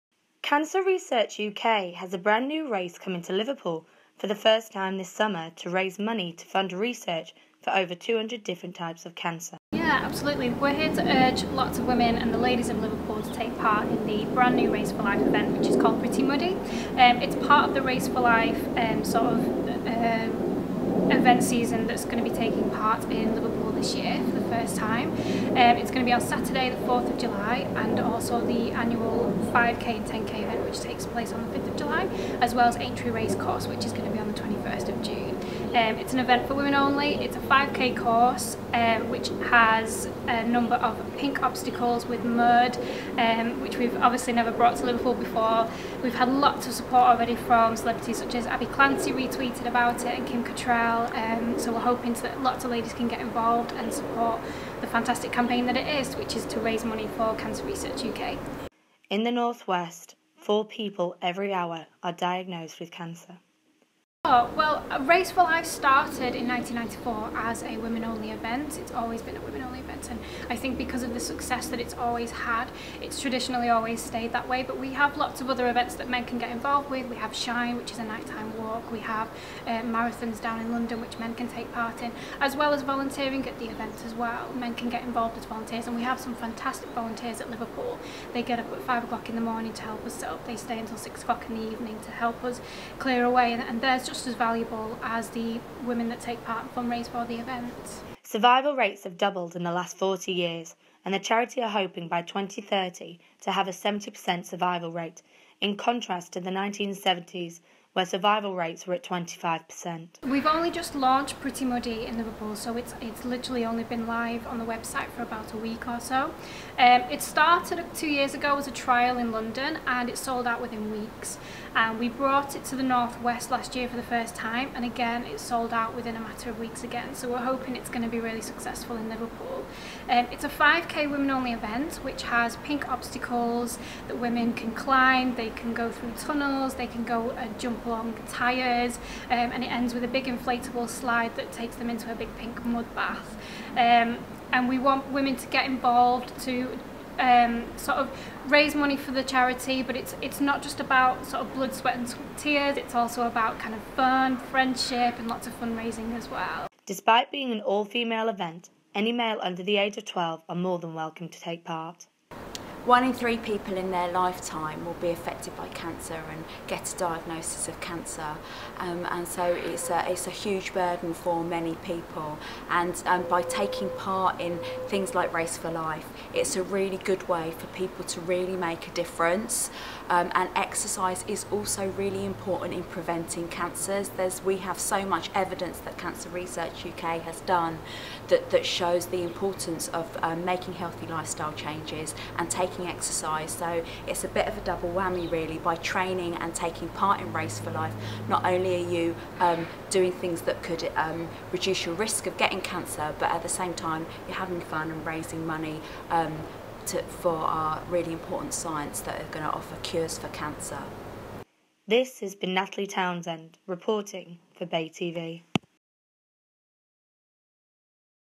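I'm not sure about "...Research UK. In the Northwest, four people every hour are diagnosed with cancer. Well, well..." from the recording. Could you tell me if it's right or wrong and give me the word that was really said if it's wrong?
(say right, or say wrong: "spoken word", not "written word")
right.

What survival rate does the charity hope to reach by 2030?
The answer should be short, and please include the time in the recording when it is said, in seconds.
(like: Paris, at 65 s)
70%, at 103 s.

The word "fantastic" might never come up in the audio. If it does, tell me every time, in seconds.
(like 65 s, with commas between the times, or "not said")
54 s, 86 s.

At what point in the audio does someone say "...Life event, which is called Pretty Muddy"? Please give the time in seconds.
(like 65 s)
15 s.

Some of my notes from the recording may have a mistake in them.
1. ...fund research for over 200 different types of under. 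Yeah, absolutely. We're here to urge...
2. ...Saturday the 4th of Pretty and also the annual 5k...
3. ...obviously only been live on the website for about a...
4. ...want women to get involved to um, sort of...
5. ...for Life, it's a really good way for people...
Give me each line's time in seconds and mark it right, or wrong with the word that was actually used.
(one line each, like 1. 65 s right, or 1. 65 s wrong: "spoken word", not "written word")
1. 6 s wrong: "cancer", not "under"
2. 26 s wrong: "July", not "Pretty"
3. 113 s wrong: "literally", not "obviously"
4. 144 s right
5. 175 s right.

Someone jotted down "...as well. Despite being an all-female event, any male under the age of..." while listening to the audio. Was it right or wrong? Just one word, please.
right.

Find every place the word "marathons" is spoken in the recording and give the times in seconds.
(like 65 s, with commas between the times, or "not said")
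79 s.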